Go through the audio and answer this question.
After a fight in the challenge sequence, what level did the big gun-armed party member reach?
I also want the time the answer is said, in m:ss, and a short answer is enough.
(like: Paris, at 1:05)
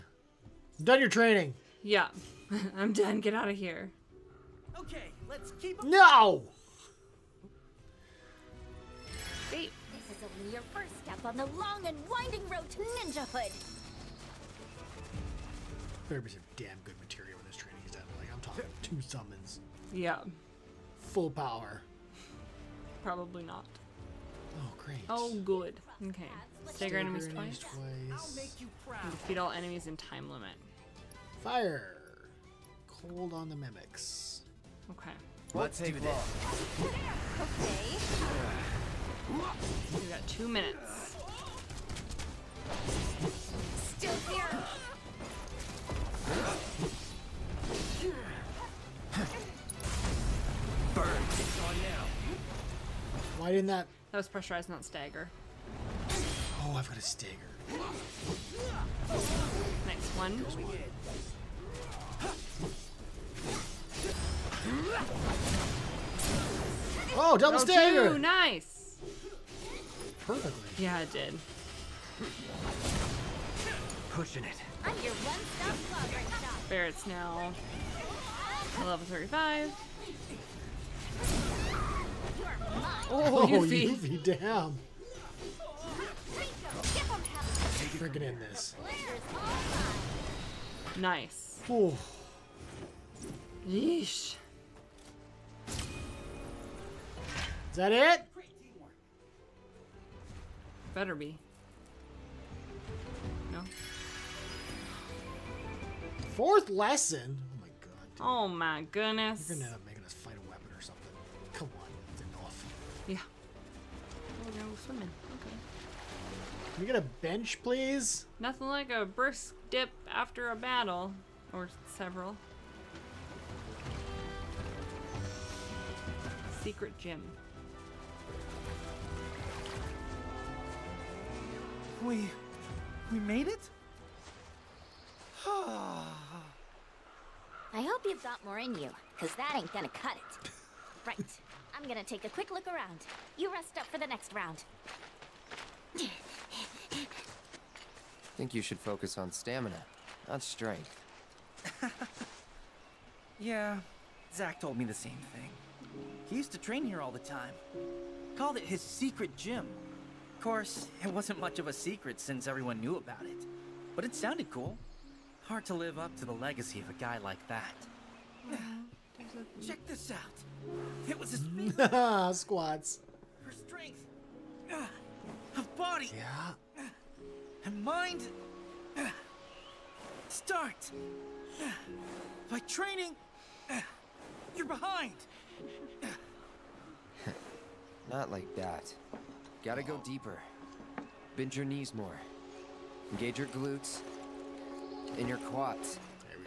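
35, at 1:18.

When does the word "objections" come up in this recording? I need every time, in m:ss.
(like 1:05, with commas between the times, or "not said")
not said.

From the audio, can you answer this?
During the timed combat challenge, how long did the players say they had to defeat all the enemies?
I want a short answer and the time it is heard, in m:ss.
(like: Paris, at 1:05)
2 minutes, at 0:40.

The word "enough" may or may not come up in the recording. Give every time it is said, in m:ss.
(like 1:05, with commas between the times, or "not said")
1:52.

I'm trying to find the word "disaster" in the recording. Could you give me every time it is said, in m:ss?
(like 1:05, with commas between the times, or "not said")
not said.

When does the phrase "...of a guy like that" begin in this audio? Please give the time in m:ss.
2:46.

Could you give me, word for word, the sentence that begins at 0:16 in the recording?
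There'd be some damn good materia when this training is done.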